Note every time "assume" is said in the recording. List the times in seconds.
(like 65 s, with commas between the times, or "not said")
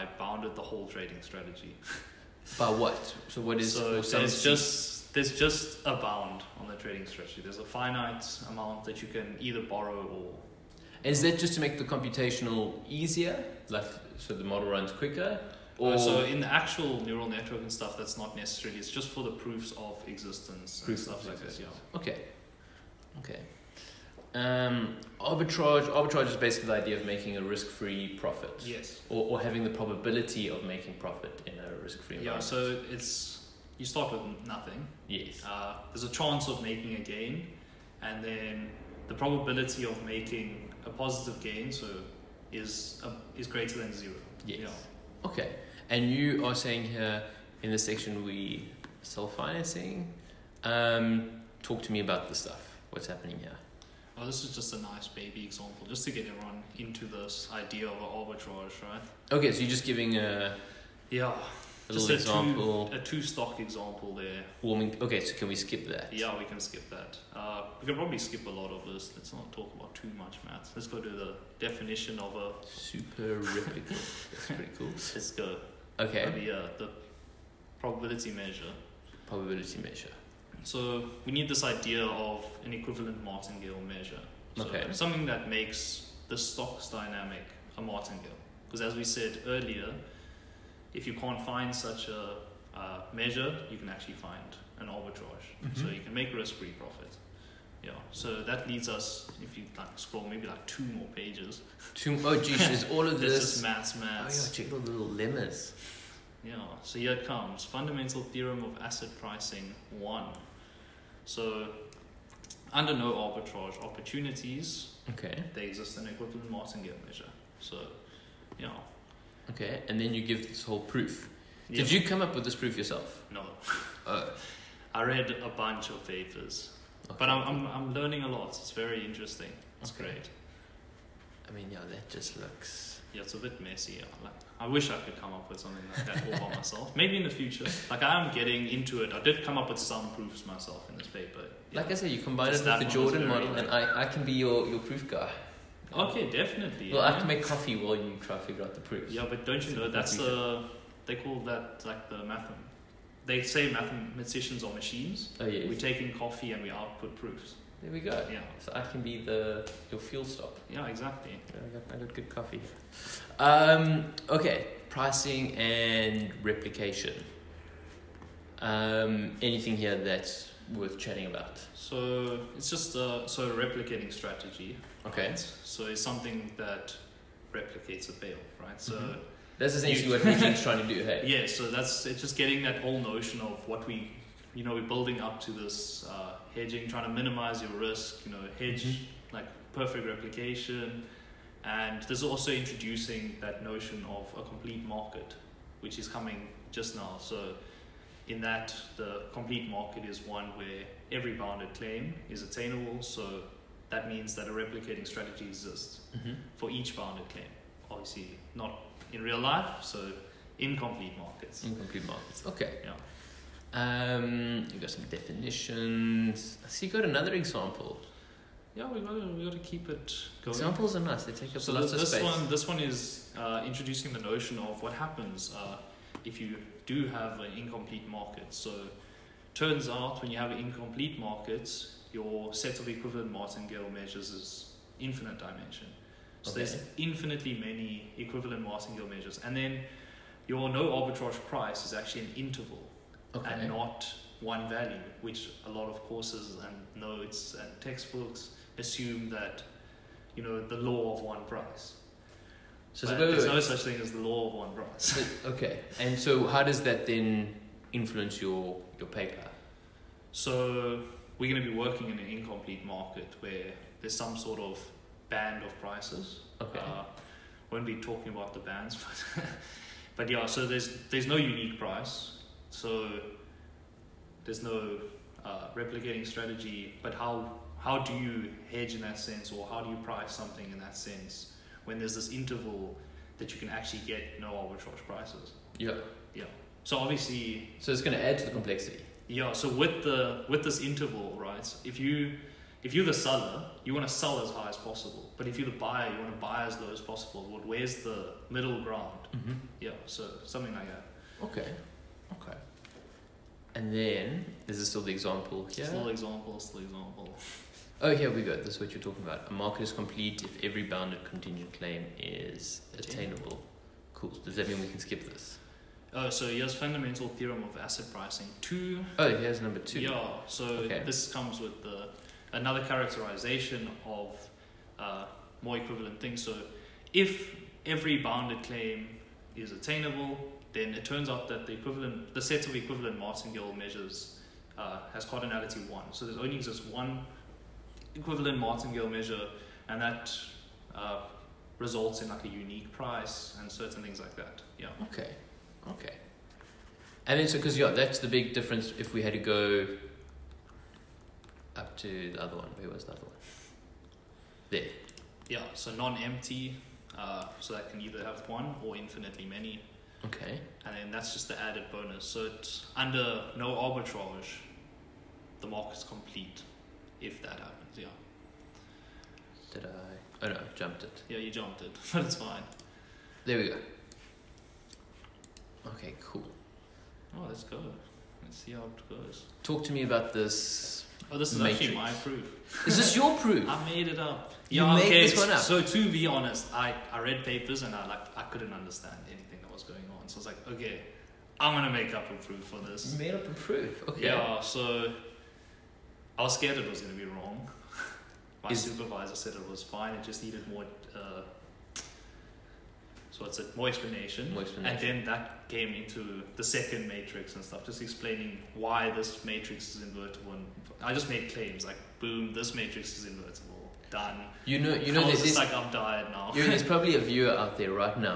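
248 s.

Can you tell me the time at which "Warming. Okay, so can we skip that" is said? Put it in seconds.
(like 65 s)
64 s.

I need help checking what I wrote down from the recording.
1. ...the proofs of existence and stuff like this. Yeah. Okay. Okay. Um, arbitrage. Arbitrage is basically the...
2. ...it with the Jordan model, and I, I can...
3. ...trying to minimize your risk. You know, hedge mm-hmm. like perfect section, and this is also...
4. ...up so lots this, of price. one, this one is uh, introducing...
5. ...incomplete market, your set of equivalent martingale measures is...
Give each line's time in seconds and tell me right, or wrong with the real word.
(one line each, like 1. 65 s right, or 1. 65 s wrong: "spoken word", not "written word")
1. 19 s right
2. 142 s right
3. 186 s wrong: "replication", not "section"
4. 221 s wrong: "space", not "price"
5. 230 s right.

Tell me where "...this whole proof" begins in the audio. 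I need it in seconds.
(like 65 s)
120 s.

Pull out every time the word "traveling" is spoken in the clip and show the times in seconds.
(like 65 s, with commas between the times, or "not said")
not said.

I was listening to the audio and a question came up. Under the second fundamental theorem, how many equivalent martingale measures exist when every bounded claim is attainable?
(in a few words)
1.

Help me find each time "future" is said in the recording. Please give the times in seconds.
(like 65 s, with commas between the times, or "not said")
137 s.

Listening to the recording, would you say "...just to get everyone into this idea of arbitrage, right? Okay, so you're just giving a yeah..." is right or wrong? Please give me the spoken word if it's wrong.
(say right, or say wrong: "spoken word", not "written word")
right.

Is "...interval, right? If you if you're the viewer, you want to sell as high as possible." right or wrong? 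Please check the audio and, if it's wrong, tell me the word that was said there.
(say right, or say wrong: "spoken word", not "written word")
wrong: "seller", not "viewer".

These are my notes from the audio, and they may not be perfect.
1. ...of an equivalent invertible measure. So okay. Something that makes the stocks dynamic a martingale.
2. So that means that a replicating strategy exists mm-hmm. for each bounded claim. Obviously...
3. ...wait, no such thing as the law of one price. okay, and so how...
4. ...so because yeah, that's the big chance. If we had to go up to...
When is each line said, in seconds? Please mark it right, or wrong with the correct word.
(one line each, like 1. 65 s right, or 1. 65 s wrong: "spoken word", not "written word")
1. 82 s wrong: "martingale", not "invertible"
2. 203 s right
3. 253 s right
4. 347 s wrong: "difference", not "chance".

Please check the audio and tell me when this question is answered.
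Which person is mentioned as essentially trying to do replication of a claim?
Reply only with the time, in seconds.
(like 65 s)
180 s.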